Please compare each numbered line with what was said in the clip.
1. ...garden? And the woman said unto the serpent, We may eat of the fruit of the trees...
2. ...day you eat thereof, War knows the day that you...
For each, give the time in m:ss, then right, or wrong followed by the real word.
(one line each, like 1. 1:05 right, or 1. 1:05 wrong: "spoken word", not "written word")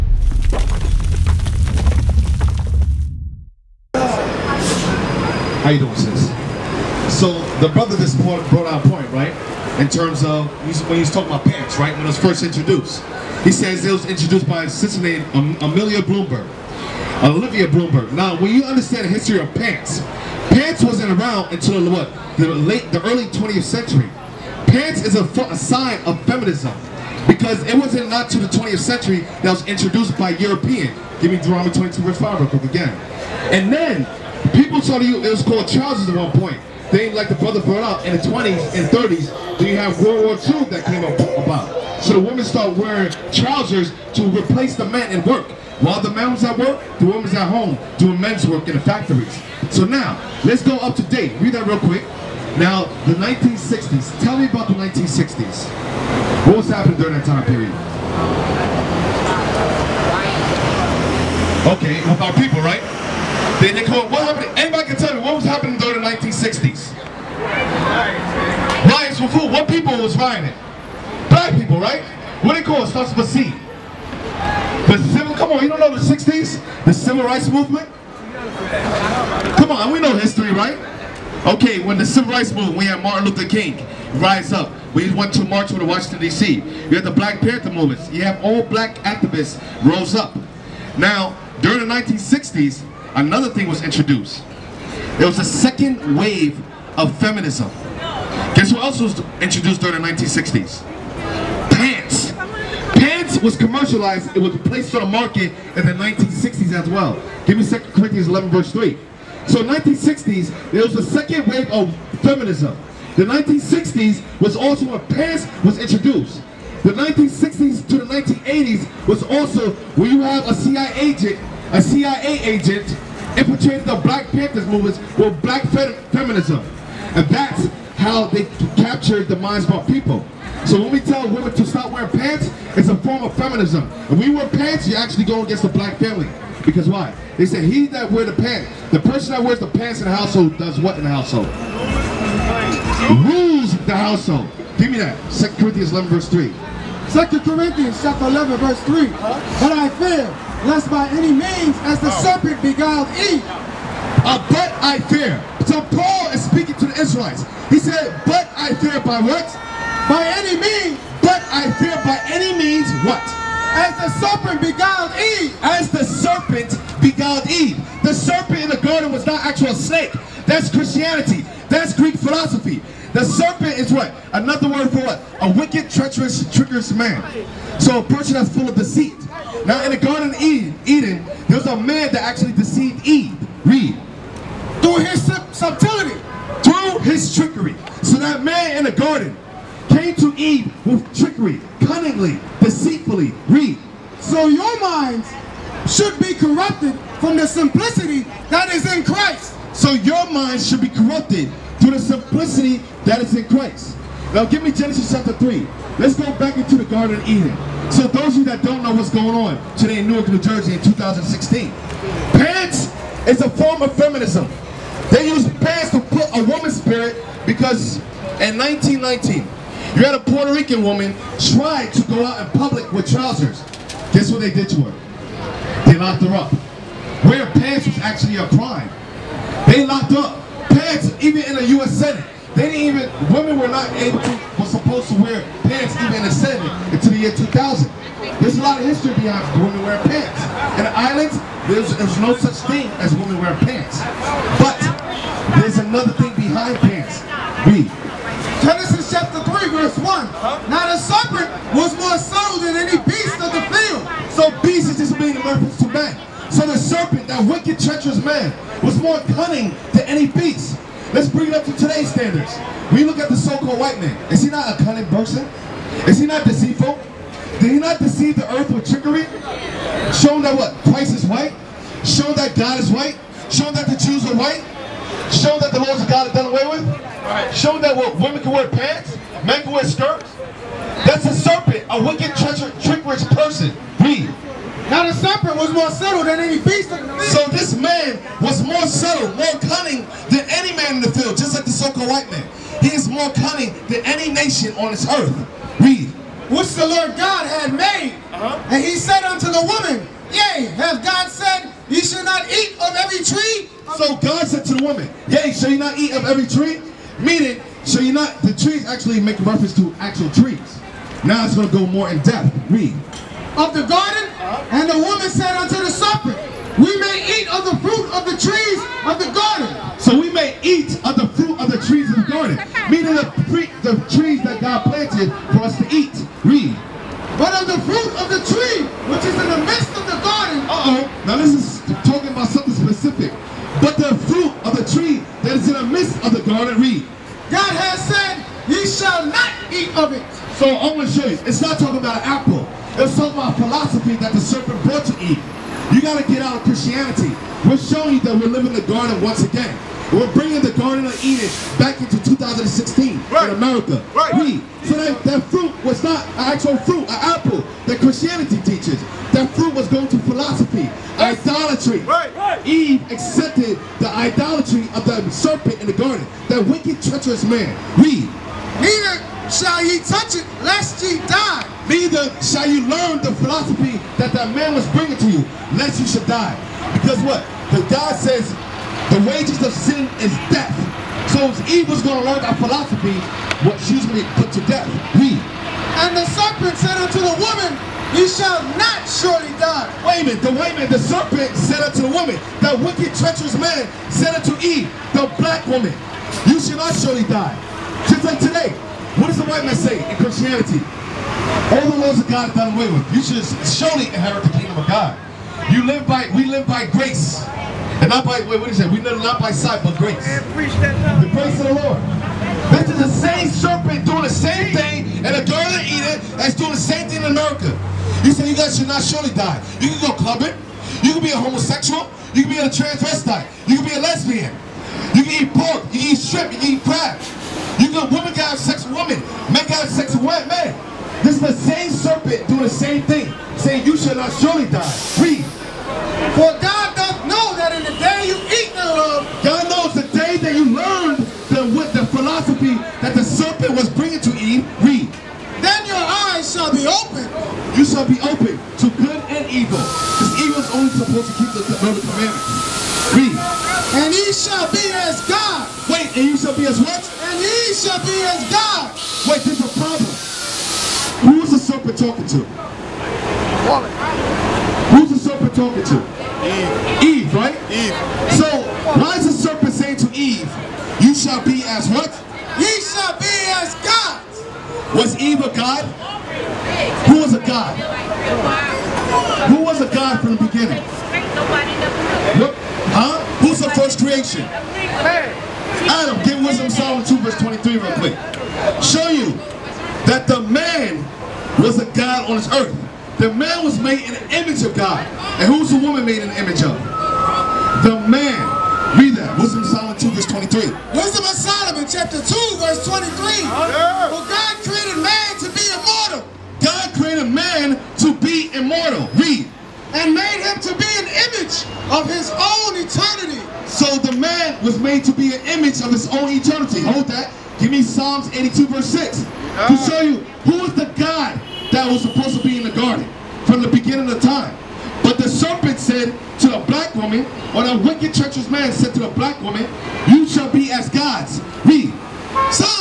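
1. 5:13 right
2. 7:17 wrong: "God", not "War".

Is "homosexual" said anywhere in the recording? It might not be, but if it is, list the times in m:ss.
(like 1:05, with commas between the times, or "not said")
7:01.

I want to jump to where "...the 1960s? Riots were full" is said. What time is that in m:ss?
1:06.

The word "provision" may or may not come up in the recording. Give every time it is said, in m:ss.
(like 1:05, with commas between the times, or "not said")
not said.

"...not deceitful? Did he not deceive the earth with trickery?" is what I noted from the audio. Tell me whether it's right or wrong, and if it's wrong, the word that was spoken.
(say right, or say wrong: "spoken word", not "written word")
right.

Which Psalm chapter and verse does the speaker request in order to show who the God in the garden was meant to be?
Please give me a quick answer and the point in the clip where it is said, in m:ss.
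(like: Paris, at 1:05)
Psalms 82:6, at 8:37.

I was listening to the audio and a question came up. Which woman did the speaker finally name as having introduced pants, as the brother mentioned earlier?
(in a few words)
Olivia Bloomberg.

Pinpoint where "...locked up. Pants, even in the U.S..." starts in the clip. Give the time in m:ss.
3:49.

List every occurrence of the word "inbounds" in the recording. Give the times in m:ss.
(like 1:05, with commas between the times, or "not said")
not said.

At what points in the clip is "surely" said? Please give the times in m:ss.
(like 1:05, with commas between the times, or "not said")
6:29, 6:36, 6:43, 6:59, 7:14.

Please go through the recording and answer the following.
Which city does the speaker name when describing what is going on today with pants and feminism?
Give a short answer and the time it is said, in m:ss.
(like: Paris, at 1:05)
Newark, New Jersey, at 3:30.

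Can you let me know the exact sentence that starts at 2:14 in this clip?
If we wear pants, you actually go against the black family.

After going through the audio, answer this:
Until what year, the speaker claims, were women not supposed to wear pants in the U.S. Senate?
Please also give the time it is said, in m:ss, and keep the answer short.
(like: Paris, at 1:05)
2000, at 3:57.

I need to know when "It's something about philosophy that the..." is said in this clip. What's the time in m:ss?
5:42.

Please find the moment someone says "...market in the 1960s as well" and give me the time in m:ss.
1:45.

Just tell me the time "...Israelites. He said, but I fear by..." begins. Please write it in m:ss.
2:37.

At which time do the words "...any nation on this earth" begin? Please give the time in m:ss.
4:54.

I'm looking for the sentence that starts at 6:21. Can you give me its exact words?
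So if evil's going to learn that philosophy, going to be put to death?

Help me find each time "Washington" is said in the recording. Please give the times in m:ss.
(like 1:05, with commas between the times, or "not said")
1:25.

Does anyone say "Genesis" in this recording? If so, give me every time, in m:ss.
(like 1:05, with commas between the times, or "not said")
3:24, 4:08.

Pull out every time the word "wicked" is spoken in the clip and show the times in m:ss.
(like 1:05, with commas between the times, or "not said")
2:55, 4:17, 4:42, 6:06, 6:32, 8:47.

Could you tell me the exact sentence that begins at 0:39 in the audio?
Then you have World War II that came about.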